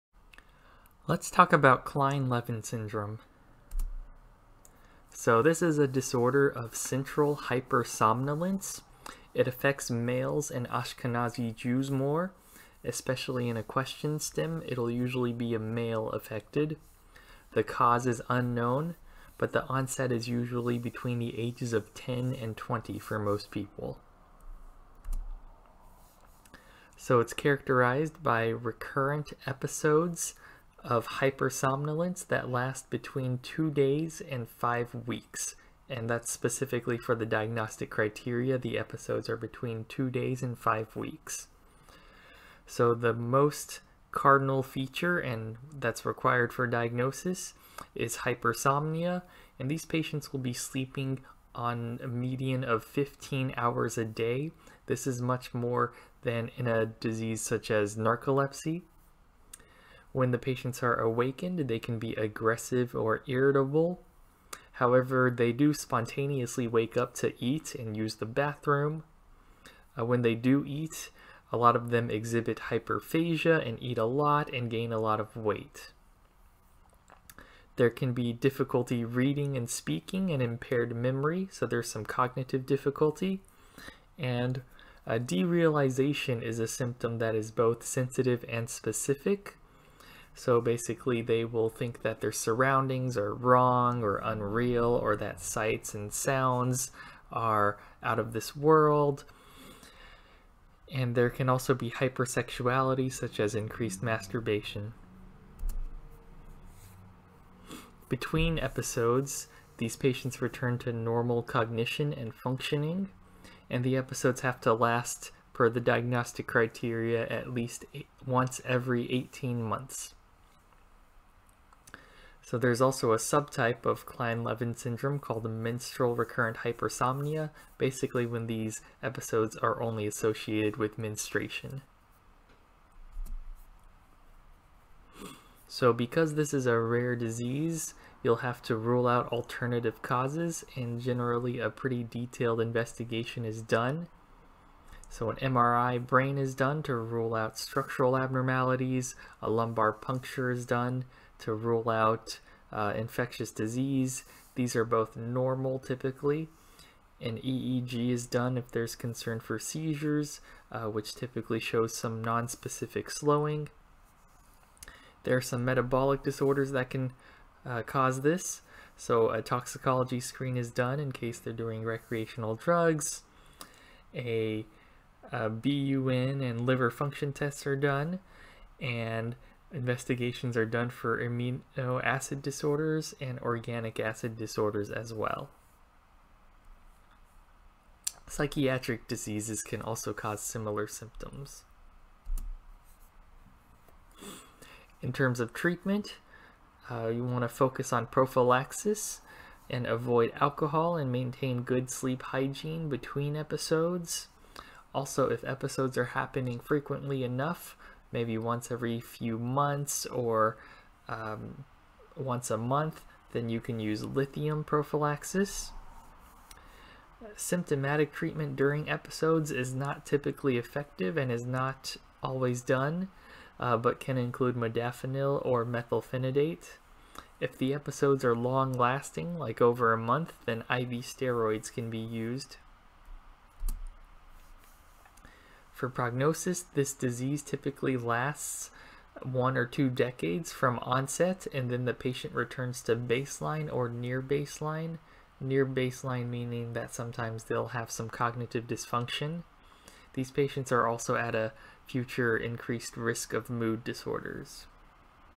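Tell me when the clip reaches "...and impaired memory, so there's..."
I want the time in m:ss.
1:20.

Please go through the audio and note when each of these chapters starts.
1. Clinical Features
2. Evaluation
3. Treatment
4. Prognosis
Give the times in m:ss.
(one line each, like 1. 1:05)
1. 0:25
2. 2:13
3. 3:13
4. 3:53.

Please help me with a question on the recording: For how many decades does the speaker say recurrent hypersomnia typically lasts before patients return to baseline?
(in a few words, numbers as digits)
1 or 2 decades.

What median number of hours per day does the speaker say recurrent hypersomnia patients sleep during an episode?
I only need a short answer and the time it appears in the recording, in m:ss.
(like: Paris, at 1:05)
15, at 0:52.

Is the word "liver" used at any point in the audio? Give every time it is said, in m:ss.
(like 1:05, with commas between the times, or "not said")
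2:56.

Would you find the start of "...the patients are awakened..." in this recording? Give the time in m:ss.
1:00.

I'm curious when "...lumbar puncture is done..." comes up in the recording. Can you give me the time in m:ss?
2:29.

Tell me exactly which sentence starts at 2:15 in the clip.
So because this is a rare disease, you'll have to rule out alternative causes and generally a pretty detailed investigation is done.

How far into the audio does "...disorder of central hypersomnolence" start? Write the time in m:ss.
0:05.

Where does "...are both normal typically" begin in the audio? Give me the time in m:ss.
2:34.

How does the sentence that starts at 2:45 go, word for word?
There are some metabolic disorders that can uh, cause this.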